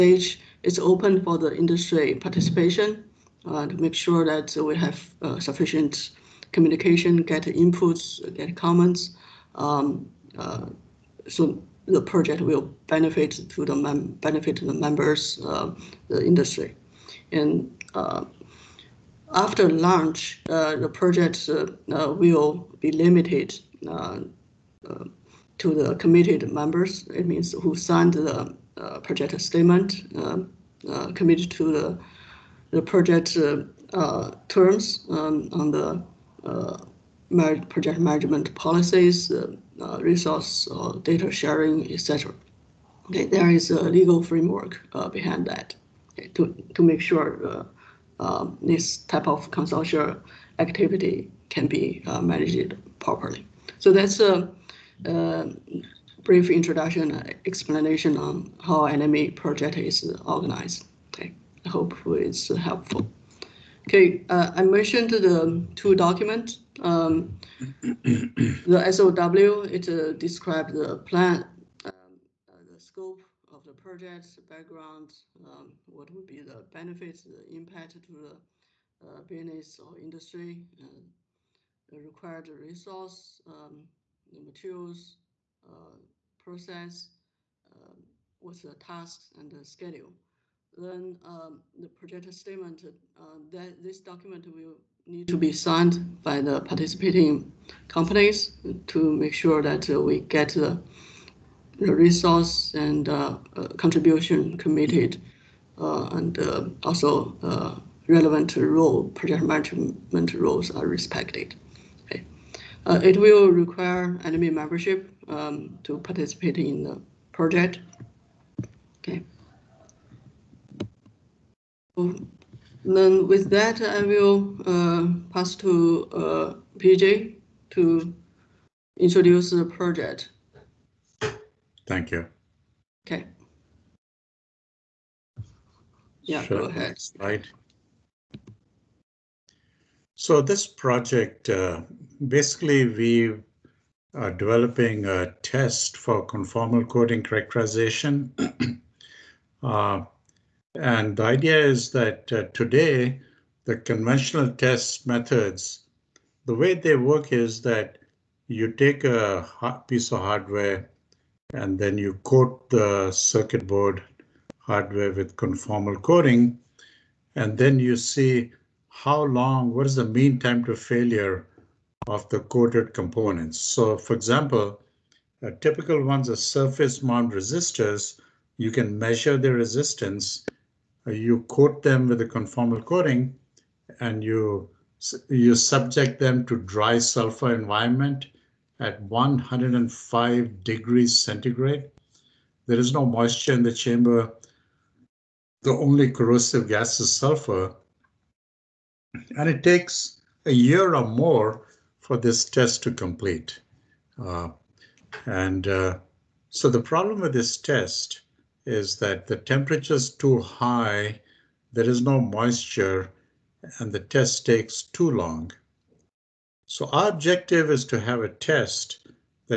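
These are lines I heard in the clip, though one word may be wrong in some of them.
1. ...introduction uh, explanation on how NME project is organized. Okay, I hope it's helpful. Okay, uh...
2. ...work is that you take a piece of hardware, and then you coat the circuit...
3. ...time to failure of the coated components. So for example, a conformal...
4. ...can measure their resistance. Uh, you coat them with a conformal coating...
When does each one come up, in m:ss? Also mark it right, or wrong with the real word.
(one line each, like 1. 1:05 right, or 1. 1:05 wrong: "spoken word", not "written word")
1. 0:56 right
2. 2:36 right
3. 2:50 wrong: "typical", not "conformal"
4. 2:58 right.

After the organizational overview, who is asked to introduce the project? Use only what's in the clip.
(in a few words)
PJ.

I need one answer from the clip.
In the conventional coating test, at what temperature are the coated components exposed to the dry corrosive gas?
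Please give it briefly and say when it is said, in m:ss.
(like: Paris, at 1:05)
105 degrees centigrade, at 3:09.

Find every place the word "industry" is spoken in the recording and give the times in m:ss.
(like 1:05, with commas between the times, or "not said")
0:01, 0:16, 1:19.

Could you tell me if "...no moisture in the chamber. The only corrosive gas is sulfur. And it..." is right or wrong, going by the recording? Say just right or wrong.
right.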